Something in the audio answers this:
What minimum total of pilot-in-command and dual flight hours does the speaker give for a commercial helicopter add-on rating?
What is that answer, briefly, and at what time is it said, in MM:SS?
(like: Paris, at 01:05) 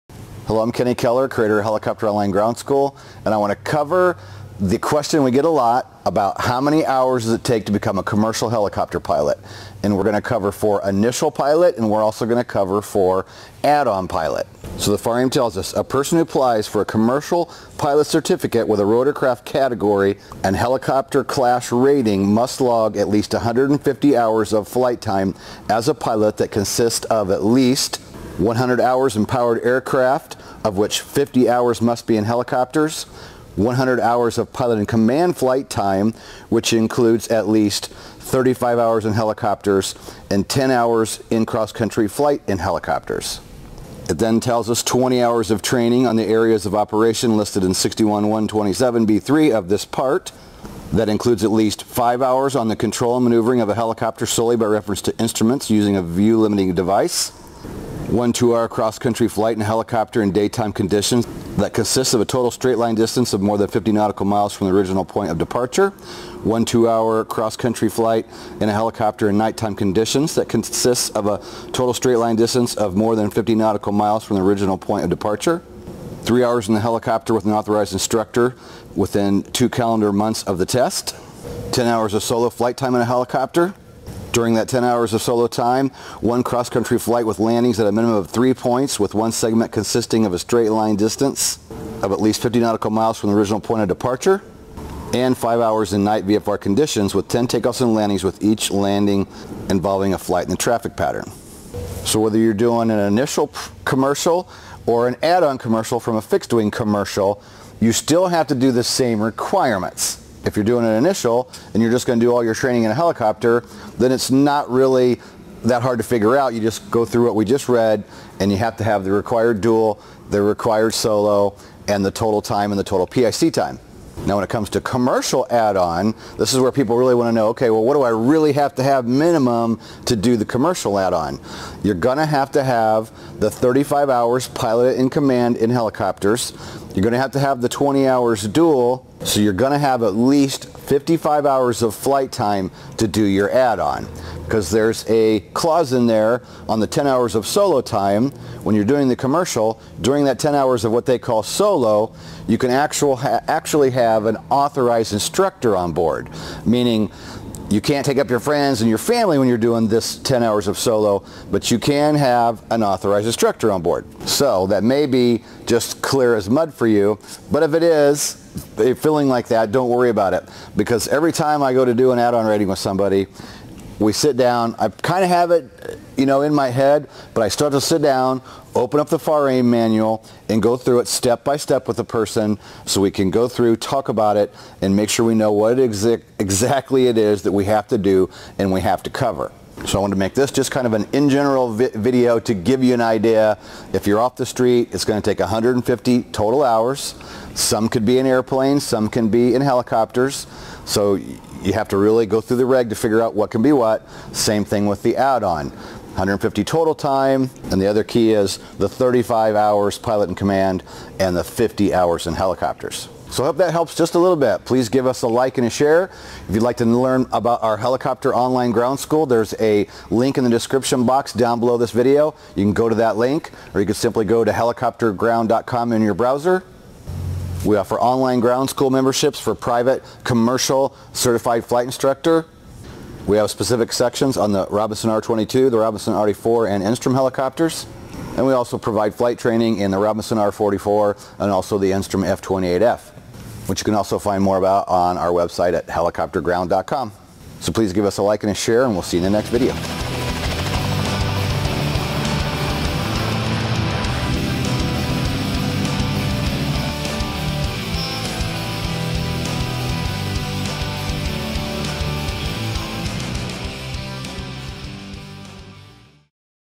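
55 hours, at 02:20.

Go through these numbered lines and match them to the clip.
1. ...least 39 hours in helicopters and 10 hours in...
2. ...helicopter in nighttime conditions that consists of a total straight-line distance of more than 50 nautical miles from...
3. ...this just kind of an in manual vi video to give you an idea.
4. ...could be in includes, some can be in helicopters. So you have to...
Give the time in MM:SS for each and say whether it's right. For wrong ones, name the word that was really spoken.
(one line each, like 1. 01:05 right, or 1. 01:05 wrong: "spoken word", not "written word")
1. 00:37 wrong: "35", not "39"
2. 01:08 right
3. 03:10 wrong: "general", not "manual"
4. 03:17 wrong: "airplanes", not "includes".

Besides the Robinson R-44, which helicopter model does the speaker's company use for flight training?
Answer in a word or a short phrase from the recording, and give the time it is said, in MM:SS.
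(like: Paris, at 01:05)
Enstrom F-28F, at 04:01.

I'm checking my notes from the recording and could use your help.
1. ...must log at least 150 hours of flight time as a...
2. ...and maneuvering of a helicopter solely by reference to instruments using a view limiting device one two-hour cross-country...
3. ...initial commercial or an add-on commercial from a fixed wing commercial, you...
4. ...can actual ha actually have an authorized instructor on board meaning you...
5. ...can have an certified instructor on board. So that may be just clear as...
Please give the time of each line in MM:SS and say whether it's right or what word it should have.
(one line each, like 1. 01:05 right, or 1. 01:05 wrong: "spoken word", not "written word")
1. 00:22 right
2. 00:53 right
3. 01:42 right
4. 02:32 right
5. 02:41 wrong: "authorized", not "certified".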